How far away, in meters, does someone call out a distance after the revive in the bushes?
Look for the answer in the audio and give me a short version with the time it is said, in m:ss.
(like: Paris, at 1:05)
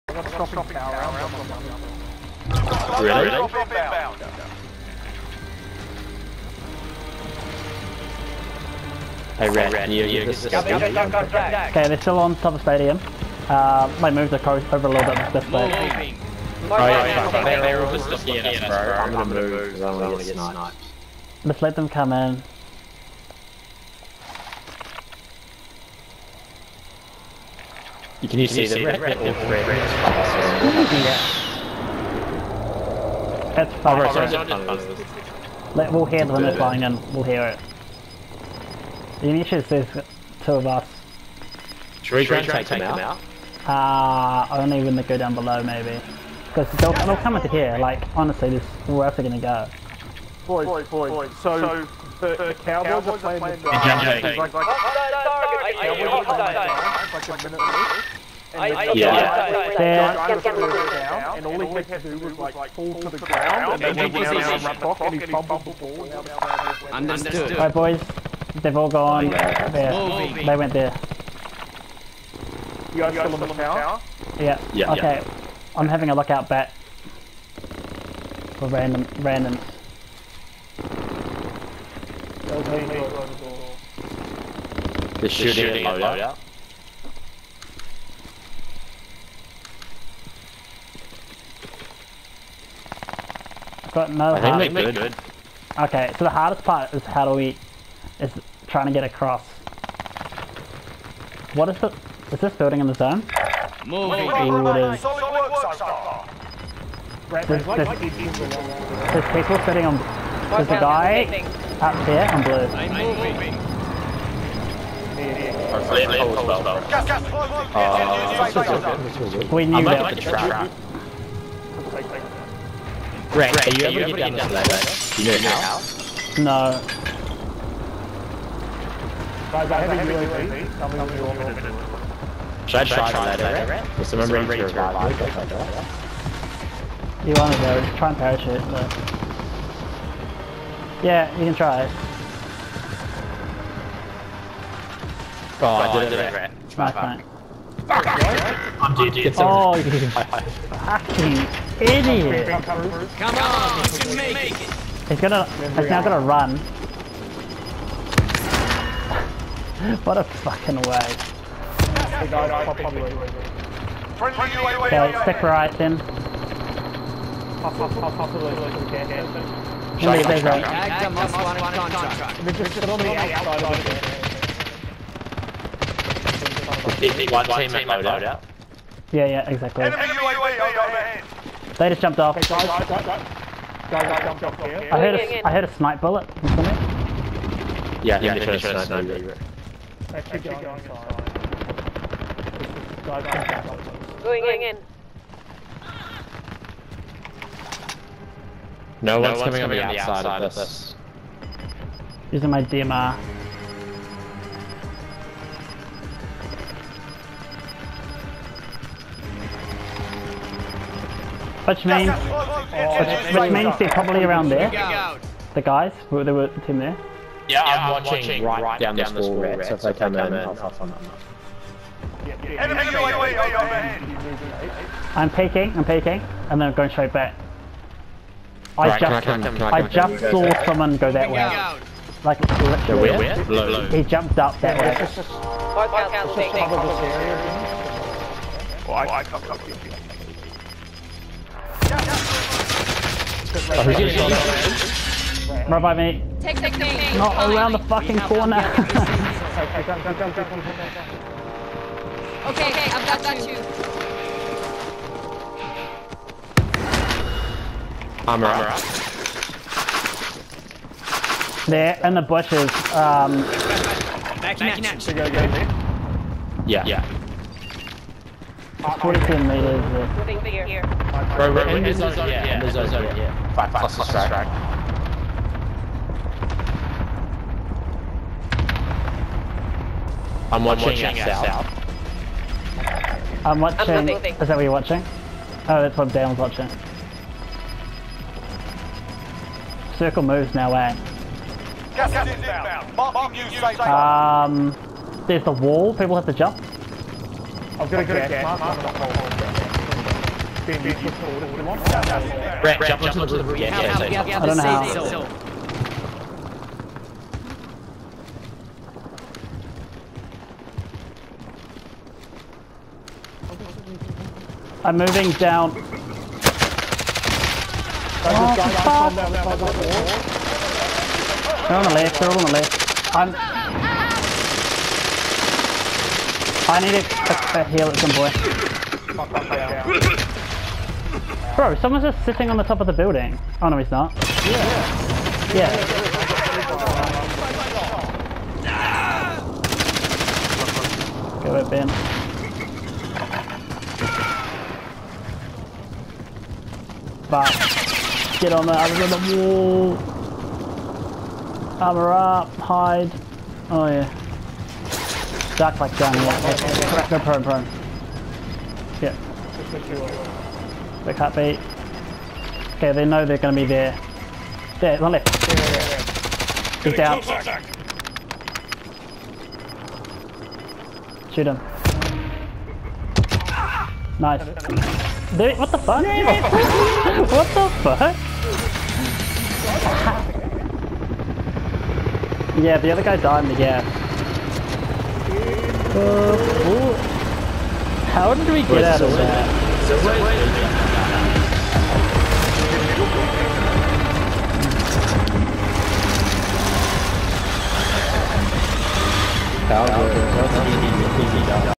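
42 meters, at 4:28.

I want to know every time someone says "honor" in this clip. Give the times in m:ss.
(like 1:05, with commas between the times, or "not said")
not said.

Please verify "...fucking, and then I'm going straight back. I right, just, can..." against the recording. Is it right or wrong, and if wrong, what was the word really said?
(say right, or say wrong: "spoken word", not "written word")
wrong: "peeking", not "fucking".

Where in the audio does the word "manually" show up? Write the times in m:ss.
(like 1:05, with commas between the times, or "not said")
not said.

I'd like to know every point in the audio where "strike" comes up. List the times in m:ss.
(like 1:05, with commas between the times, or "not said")
4:34.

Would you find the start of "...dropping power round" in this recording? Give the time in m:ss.
0:00.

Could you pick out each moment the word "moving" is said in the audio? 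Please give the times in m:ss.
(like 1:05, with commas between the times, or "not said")
1:43, 1:53, 5:14.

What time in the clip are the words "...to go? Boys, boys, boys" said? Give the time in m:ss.
0:49.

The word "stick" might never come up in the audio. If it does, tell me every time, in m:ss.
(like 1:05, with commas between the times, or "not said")
2:45.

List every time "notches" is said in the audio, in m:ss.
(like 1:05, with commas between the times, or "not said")
not said.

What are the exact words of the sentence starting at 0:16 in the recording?
Oh, yeah, yeah, they're all just looking at us, bro.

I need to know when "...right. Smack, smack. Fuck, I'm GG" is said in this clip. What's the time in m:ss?
2:26.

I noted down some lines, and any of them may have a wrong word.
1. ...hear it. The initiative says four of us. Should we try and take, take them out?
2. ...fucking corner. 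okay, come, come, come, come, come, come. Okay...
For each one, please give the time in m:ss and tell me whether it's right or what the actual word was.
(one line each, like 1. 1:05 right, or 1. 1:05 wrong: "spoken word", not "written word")
1. 0:37 wrong: "two", not "four"
2. 4:07 right.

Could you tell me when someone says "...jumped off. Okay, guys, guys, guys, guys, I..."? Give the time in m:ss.
3:02.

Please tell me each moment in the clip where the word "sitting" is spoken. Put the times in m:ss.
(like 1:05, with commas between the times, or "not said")
1:49, 5:32.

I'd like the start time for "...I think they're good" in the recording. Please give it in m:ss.
1:34.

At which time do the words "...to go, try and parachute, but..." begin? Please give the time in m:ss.
2:17.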